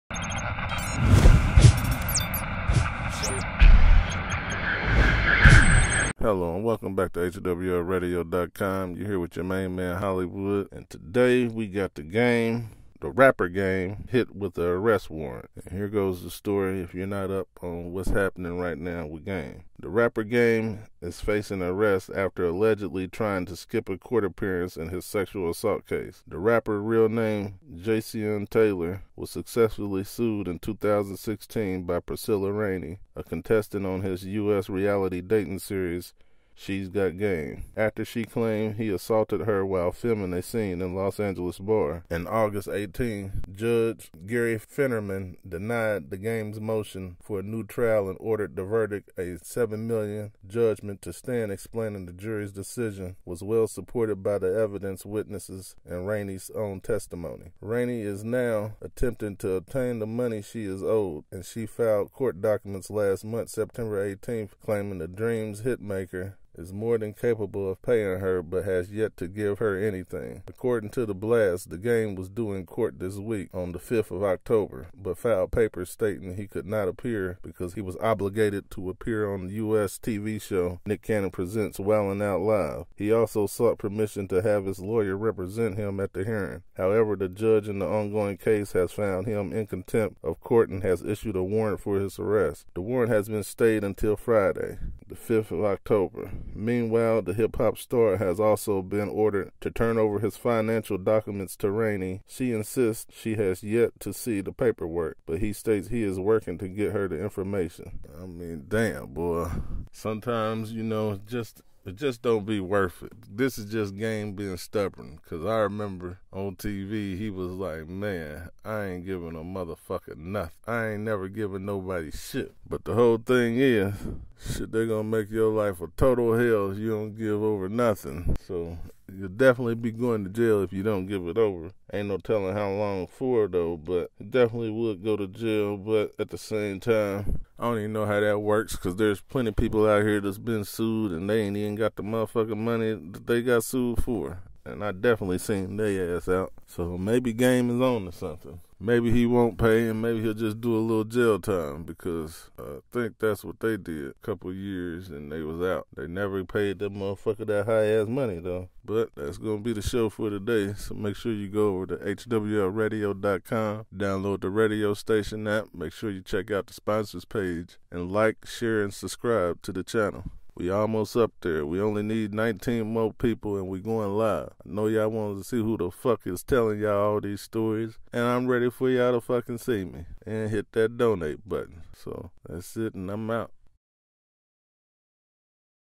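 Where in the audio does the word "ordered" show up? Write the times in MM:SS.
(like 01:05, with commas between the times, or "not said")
00:48, 01:39.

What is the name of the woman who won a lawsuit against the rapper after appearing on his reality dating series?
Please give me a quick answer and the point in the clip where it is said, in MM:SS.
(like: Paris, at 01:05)
Priscilla Rainey, at 00:32.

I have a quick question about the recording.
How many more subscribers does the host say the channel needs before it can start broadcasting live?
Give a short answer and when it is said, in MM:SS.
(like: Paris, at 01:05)
19, at 02:52.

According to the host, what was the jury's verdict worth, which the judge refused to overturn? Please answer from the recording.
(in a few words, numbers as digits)
7 million.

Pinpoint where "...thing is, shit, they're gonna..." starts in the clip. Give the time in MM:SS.
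02:03.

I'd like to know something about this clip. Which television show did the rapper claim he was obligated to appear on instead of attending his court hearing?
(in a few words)
Nick Cannon Presents Wildin' Out Live.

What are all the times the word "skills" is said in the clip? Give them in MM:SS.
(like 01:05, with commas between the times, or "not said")
not said.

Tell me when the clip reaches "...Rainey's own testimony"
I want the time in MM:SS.
00:56.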